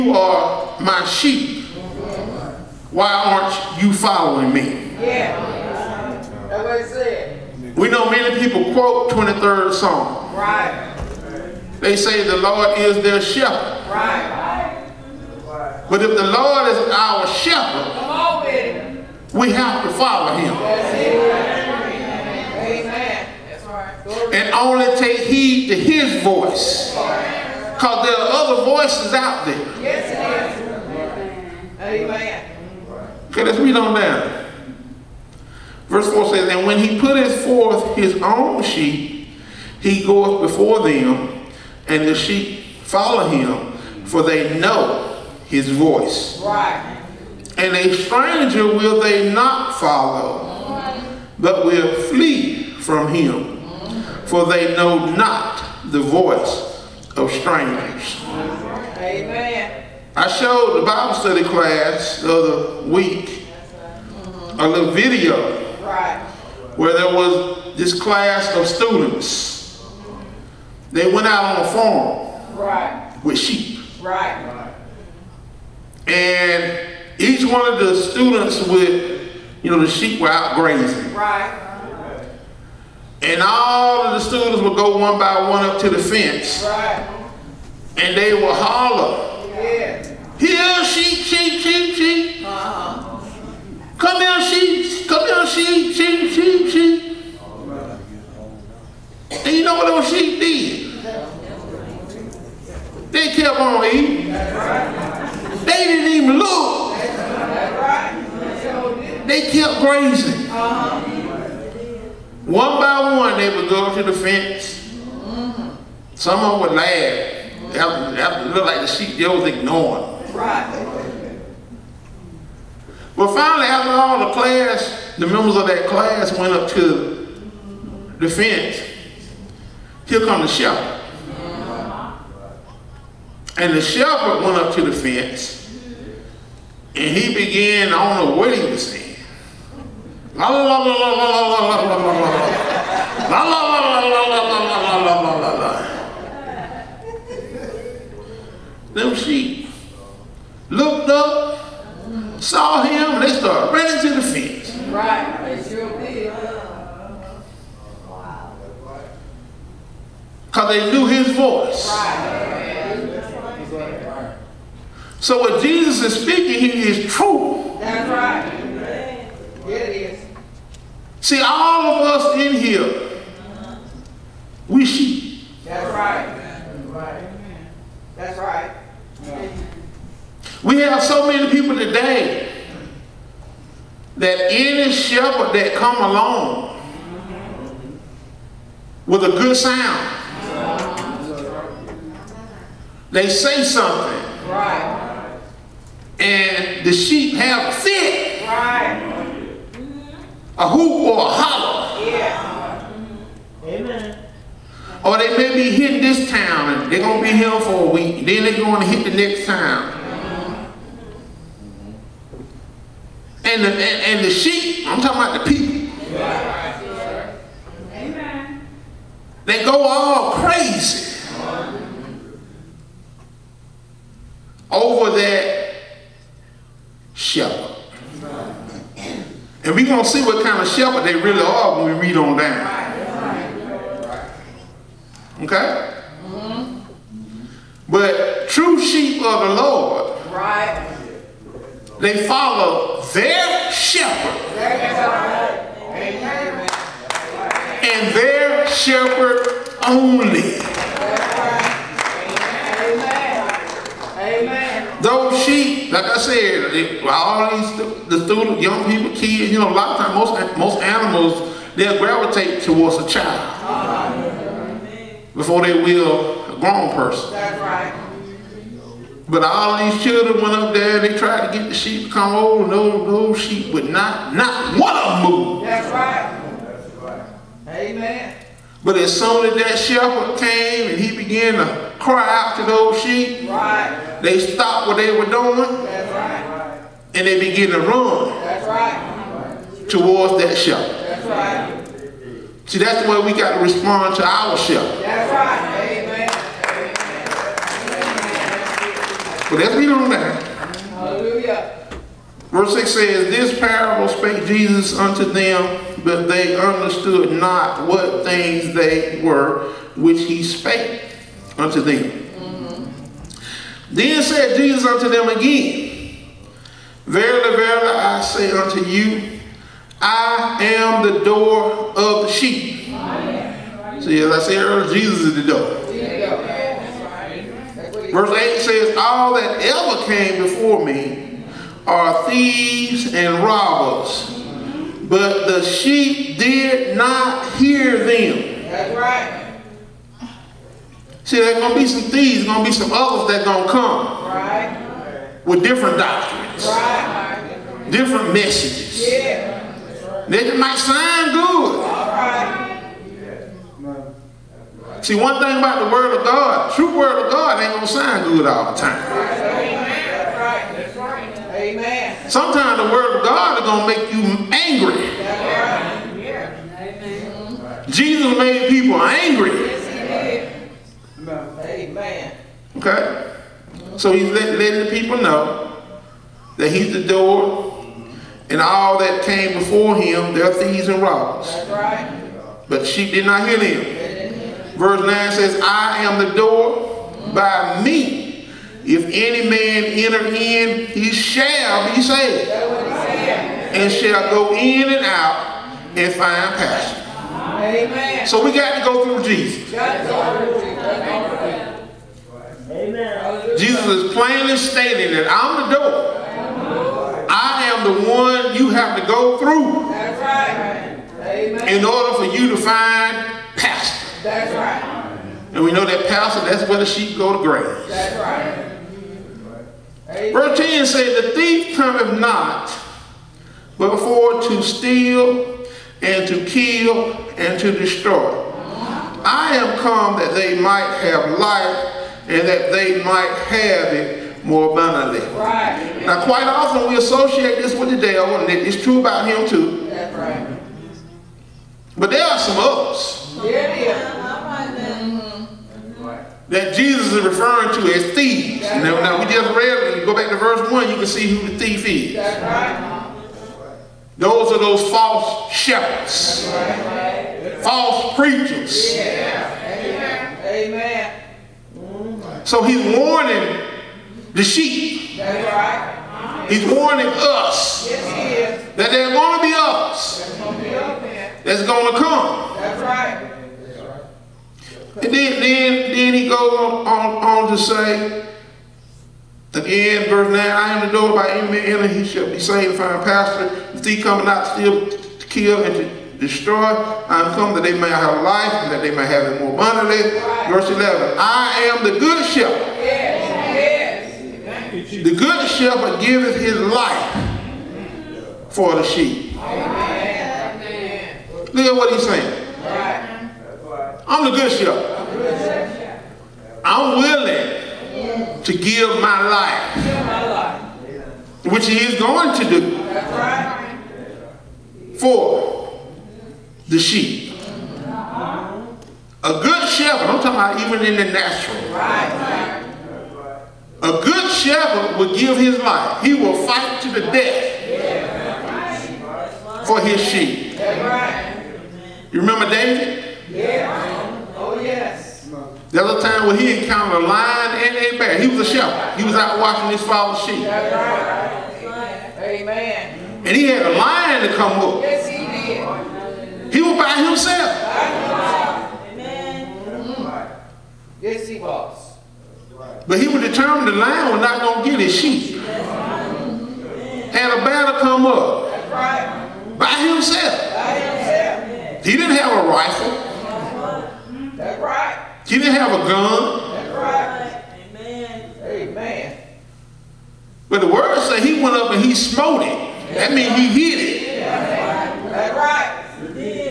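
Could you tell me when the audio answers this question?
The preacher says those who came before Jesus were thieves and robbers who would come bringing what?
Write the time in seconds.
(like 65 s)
345 s.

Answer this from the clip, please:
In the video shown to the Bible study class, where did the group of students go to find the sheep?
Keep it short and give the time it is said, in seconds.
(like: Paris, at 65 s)
a farm, at 71 s.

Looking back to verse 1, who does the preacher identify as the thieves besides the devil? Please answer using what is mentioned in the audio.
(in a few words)
false shepherds.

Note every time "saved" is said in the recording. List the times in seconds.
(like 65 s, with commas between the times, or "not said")
392 s, 482 s.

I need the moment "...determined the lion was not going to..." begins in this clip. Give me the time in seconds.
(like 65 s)
553 s.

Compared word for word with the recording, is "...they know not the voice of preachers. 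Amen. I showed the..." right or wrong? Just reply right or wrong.
wrong.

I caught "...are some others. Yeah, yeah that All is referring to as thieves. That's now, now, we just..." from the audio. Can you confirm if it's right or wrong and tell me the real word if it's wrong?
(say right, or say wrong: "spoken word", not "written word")
wrong: "Jesus", not "All".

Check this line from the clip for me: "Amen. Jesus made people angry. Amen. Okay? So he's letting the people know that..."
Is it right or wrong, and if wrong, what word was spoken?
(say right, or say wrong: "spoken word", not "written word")
right.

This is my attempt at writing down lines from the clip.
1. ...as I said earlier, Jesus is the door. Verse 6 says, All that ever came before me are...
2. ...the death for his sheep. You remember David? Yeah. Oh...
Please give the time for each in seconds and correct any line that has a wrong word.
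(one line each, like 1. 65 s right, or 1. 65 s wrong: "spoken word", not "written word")
1. 324 s wrong: "8", not "6"
2. 526 s right.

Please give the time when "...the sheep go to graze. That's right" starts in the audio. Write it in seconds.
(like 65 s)
416 s.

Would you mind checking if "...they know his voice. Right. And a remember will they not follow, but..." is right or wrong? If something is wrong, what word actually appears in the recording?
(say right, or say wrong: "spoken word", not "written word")
wrong: "stranger", not "remember".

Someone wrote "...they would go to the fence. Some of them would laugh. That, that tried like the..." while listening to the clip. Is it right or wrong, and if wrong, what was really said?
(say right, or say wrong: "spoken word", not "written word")
wrong: "looked", not "tried".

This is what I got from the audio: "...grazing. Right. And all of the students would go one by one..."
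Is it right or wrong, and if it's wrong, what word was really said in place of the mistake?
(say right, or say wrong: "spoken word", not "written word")
right.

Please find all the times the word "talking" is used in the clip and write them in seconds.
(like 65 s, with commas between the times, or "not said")
215 s, 520 s.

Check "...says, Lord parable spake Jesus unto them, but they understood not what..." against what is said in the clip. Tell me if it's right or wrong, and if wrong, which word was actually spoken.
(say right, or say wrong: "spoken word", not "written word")
wrong: "This", not "Lord".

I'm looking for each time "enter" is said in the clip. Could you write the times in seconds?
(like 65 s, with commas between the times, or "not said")
389 s, 481 s.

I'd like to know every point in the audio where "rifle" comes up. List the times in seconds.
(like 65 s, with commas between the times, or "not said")
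562 s.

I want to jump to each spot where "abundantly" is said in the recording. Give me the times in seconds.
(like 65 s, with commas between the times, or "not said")
434 s, 489 s.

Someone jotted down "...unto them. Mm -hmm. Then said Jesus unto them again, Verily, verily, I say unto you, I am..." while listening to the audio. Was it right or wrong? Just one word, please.
right.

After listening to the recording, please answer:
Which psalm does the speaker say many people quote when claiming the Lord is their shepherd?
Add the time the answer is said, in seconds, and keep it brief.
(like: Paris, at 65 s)
23rd Psalm, at 9 s.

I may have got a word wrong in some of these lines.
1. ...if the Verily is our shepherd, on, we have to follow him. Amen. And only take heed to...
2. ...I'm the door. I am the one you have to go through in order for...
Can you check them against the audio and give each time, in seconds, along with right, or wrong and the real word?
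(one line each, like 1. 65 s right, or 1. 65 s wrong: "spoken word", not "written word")
1. 16 s wrong: "Lord", not "Verily"
2. 405 s right.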